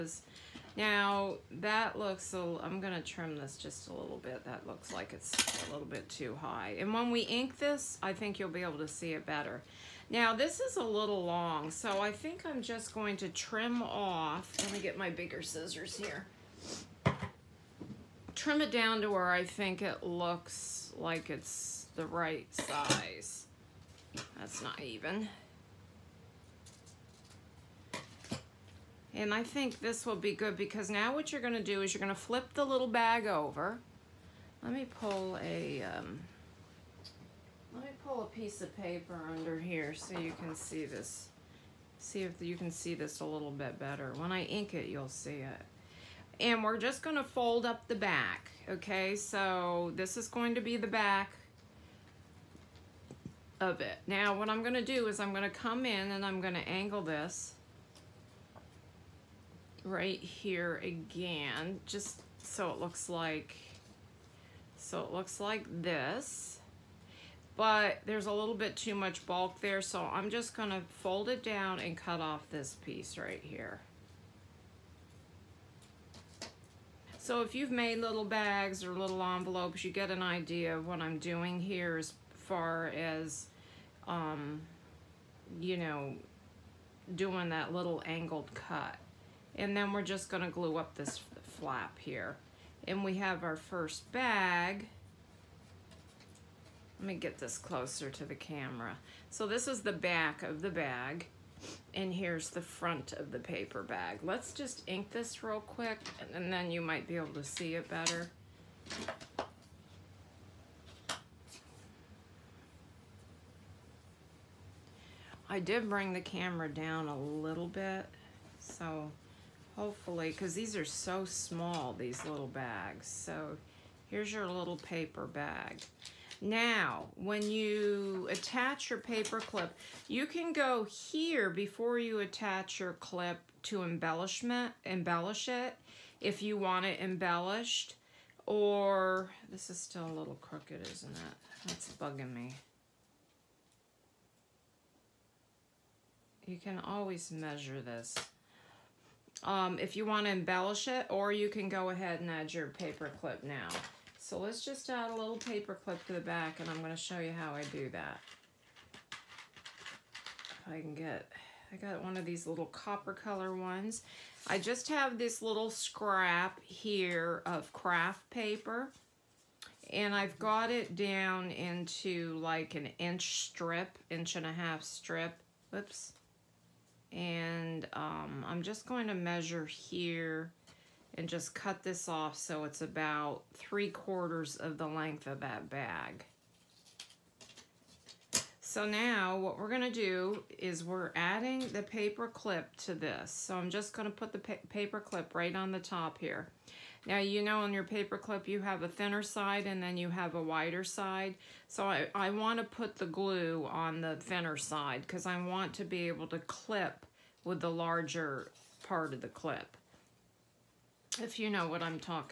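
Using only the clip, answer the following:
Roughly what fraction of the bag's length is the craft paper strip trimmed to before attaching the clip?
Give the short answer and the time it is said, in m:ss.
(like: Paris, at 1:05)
Three quarters, at 3:03.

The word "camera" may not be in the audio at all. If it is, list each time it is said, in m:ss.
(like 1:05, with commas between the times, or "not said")
1:38, 1:56.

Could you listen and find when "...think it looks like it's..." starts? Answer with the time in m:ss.
0:19.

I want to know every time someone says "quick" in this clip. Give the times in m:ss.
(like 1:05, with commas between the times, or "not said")
1:45.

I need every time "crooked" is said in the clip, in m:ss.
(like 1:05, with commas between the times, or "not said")
2:20.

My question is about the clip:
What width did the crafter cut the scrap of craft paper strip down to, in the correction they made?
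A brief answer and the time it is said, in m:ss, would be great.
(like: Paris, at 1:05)
Inch and a half, at 2:54.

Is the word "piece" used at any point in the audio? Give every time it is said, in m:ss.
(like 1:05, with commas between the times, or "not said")
0:38, 1:12.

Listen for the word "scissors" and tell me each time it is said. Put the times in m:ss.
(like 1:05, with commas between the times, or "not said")
0:15.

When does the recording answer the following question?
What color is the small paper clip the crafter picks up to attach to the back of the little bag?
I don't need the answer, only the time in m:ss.
2:42.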